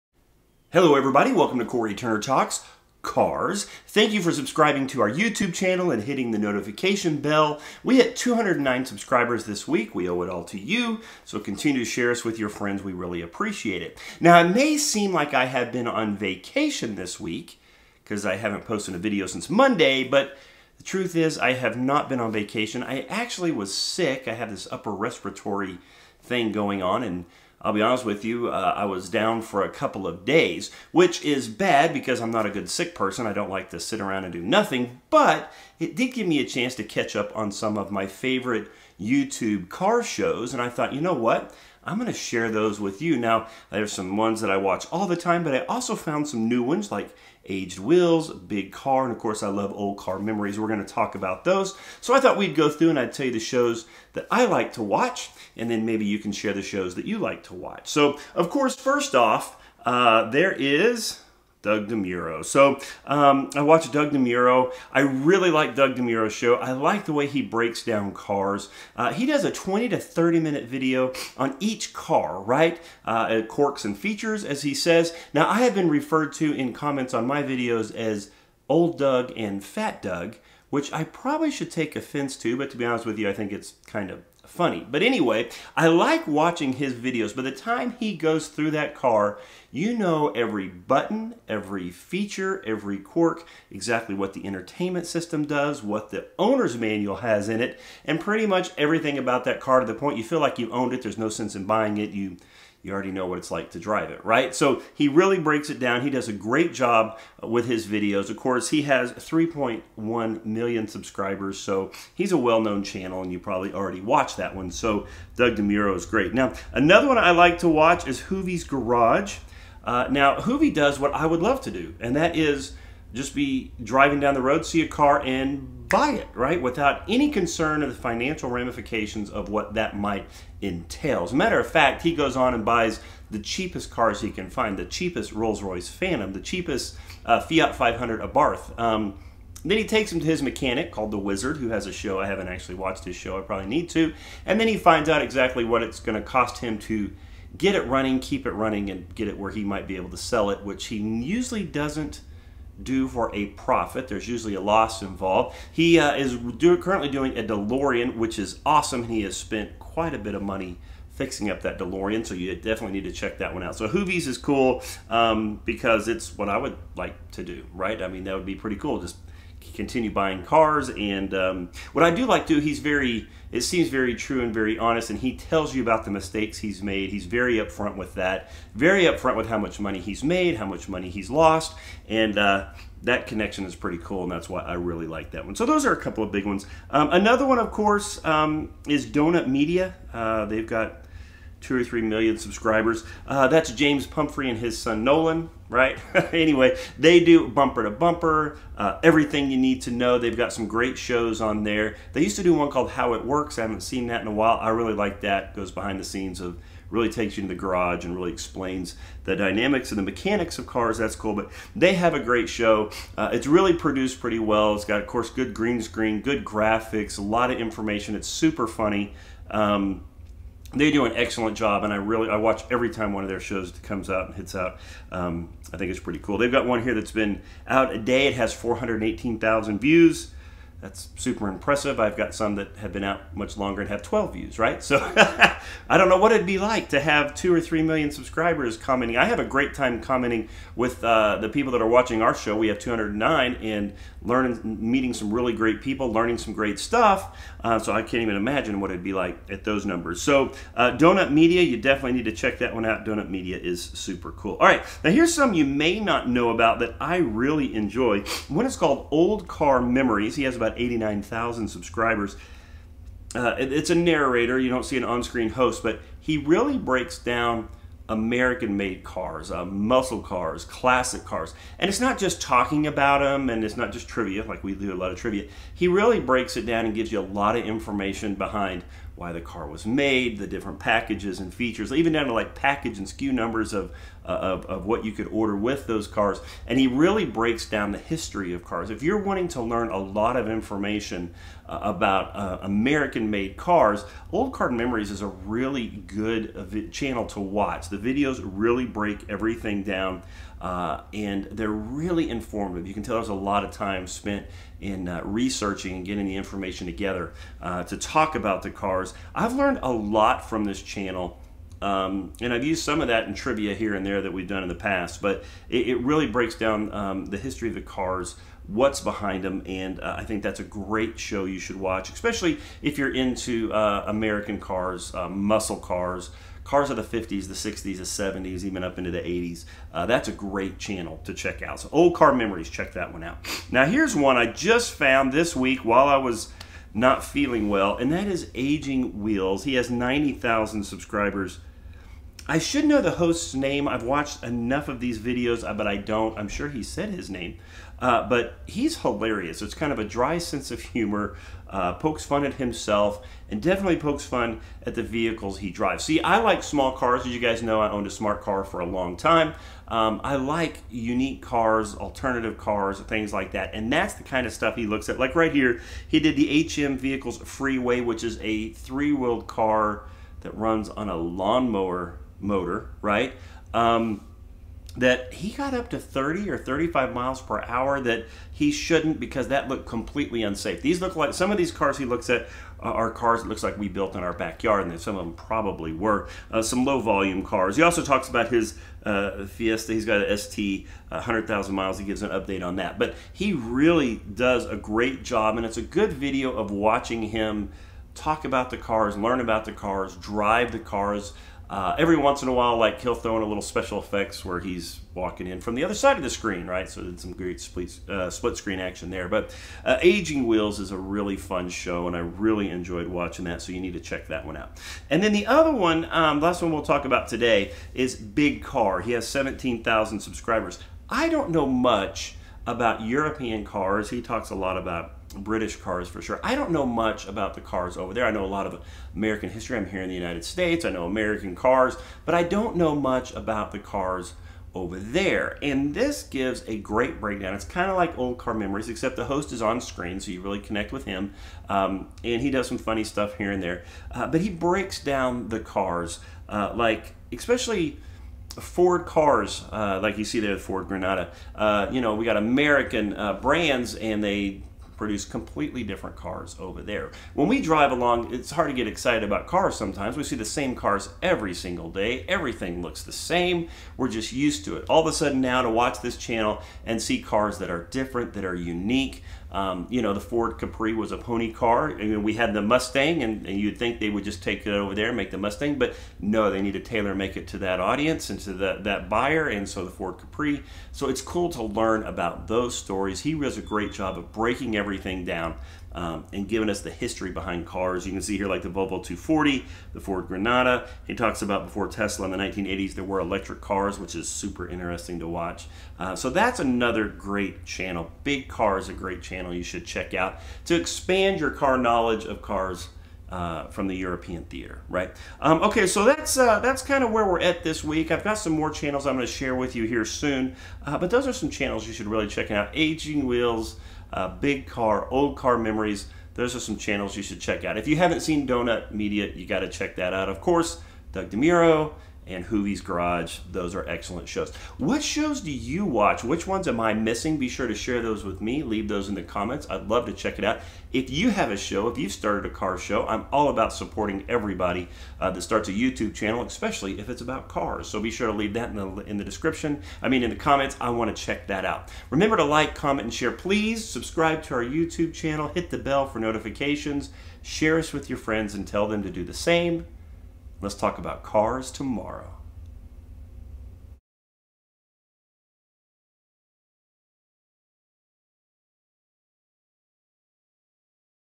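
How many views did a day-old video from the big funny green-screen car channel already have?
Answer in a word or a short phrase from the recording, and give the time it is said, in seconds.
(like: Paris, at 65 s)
418,000, at 228 s.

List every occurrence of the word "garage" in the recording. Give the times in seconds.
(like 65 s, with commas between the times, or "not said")
118 s, 207 s, 522 s.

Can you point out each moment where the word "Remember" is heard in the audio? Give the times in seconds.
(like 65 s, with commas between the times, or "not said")
542 s.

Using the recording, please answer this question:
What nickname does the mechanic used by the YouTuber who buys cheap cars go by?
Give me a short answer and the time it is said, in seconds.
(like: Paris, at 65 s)
The Wizard, at 141 s.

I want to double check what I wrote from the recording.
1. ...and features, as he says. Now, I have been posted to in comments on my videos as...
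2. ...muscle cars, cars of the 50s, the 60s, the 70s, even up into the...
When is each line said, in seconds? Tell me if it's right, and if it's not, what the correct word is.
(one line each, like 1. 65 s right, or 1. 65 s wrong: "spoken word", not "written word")
1. 73 s wrong: "referred", not "posted"
2. 325 s right.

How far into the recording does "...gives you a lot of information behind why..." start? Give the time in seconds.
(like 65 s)
276 s.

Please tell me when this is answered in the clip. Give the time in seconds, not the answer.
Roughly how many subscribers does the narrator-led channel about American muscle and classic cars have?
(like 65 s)
260 s.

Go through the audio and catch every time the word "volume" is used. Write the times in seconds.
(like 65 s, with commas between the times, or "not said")
386 s.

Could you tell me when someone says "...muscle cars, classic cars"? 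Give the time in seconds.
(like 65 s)
269 s.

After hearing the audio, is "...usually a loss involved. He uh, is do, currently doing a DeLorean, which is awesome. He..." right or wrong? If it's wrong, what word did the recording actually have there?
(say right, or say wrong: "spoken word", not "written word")
right.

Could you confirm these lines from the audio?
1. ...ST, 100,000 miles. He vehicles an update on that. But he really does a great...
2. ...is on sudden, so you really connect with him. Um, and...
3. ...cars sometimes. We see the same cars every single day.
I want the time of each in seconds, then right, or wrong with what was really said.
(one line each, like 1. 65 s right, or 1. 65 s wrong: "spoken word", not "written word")
1. 390 s wrong: "gives", not "vehicles"
2. 439 s wrong: "screen", not "sudden"
3. 459 s right.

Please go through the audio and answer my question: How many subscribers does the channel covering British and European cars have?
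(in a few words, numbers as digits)
17,000.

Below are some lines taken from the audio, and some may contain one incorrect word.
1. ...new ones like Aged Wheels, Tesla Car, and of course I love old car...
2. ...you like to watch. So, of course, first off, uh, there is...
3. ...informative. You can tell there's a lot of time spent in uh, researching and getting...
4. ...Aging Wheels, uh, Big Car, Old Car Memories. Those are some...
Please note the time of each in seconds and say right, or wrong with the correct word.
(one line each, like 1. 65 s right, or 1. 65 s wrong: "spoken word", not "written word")
1. 46 s wrong: "Big", not "Tesla"
2. 57 s right
3. 302 s right
4. 512 s right.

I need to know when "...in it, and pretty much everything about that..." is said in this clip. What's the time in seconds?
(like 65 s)
97 s.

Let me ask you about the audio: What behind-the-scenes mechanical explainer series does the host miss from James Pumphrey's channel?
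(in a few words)
How It Works.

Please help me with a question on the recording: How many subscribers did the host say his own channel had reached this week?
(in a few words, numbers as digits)
209.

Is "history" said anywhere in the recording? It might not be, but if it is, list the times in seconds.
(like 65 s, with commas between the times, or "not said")
287 s, 317 s, 429 s, 486 s.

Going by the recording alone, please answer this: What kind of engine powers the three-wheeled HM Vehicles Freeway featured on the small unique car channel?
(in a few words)
lawnmower motor.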